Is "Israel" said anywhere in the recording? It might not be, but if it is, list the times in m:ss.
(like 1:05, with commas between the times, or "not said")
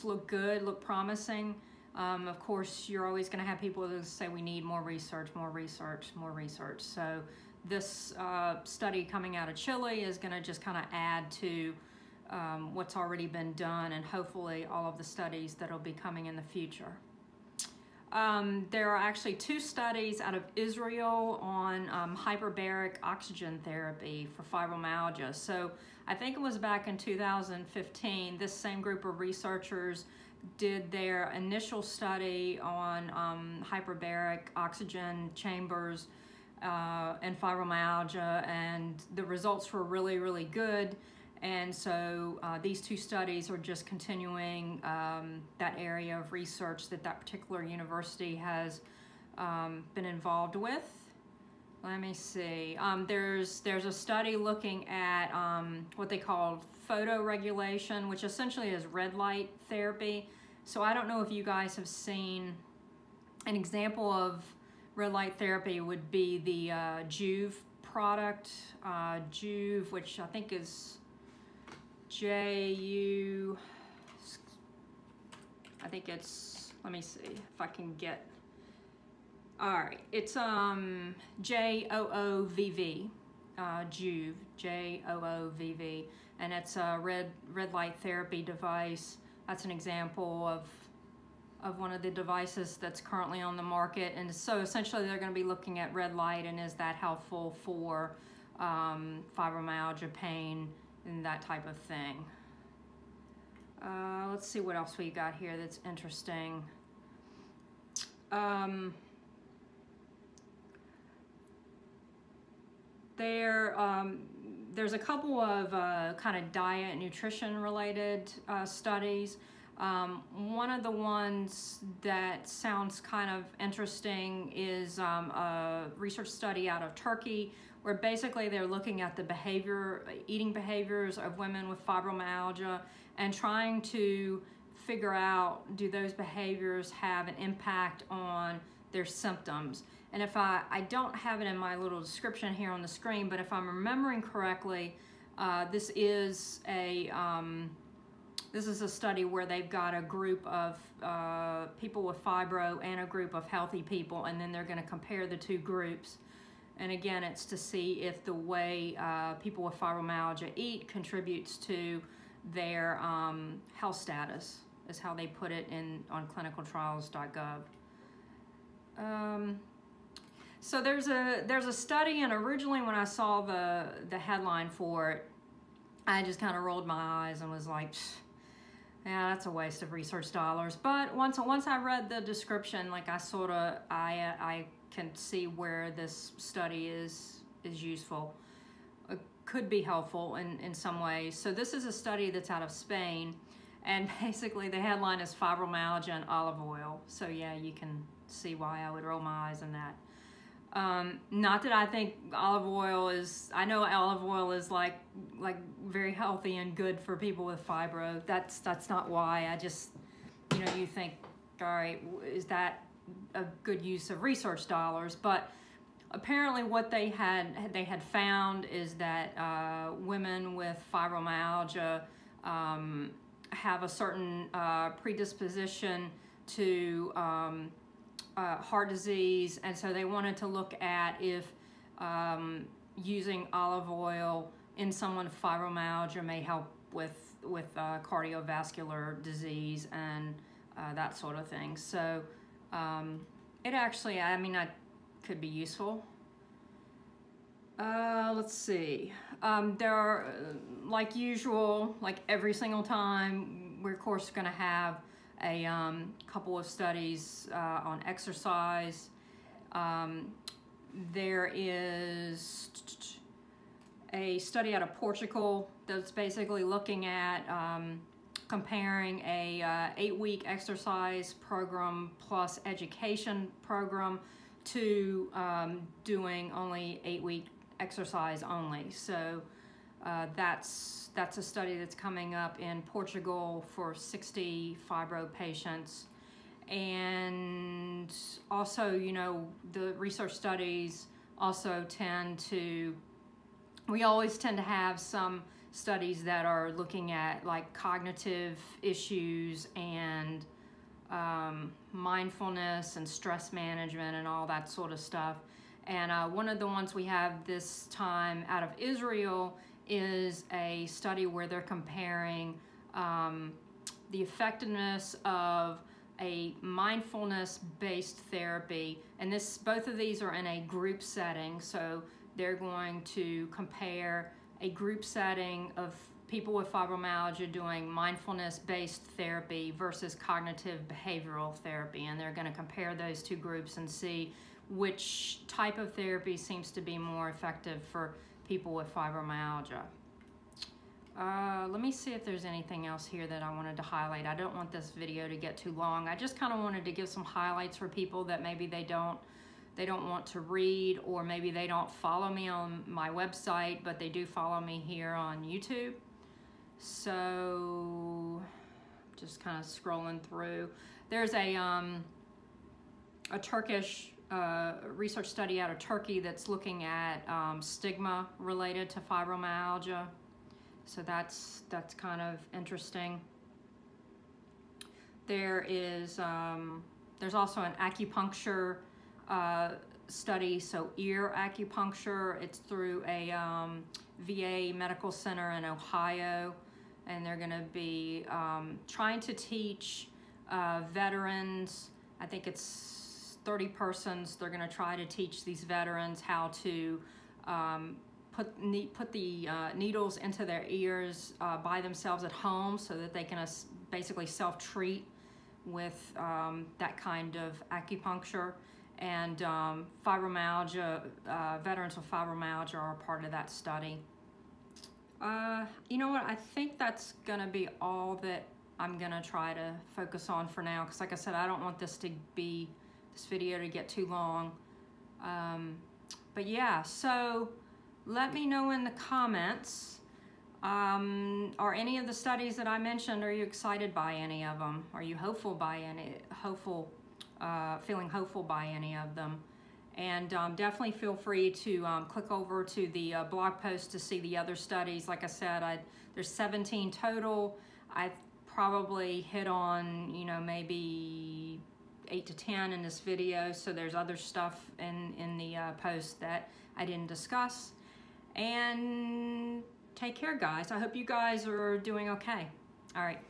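0:20, 5:08.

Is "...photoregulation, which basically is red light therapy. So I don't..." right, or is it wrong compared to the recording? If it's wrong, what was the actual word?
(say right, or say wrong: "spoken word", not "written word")
wrong: "essentially", not "basically".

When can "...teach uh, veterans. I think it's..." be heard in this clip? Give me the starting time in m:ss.
6:29.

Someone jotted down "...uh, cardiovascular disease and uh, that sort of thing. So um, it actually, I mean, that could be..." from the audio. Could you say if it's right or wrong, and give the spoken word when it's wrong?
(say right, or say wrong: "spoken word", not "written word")
right.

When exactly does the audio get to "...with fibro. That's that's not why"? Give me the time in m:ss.
3:27.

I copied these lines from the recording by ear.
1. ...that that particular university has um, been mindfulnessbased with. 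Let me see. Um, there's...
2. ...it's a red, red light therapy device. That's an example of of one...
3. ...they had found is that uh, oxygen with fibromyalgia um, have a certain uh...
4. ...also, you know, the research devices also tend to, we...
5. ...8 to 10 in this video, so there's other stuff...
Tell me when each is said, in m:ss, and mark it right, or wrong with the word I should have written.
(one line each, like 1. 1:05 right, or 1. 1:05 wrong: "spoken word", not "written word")
1. 0:46 wrong: "involved", not "mindfulnessbased"
2. 1:26 right
3. 3:37 wrong: "women", not "oxygen"
4. 4:48 wrong: "studies", not "devices"
5. 7:32 right.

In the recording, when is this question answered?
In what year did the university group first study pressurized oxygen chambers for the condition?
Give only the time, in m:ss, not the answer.
0:26.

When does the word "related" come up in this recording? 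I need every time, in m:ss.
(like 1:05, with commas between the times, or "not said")
1:57, 6:08.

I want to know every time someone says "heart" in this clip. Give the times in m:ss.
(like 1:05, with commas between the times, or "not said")
3:48.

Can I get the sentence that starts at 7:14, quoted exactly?
Are you hopeful by any, hopeful, uh, feeling hopeful by any of them?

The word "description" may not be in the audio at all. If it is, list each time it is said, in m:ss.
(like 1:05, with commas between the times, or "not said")
2:21, 3:02.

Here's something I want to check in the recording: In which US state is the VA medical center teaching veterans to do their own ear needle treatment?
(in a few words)
Ohio.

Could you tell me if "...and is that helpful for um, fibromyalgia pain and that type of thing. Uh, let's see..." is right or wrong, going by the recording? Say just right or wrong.
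right.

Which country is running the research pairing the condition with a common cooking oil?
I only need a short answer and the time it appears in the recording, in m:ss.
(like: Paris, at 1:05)
Spain, at 3:12.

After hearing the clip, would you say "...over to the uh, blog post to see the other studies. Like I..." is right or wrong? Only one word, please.
right.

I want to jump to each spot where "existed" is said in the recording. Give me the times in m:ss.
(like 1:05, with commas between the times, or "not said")
not said.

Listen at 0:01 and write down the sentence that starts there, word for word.
Um, of course, you're always gonna have people that say we need more research, more research, more research.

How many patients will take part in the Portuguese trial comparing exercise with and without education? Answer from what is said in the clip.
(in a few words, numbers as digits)
60.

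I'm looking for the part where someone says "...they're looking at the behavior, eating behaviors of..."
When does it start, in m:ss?
2:08.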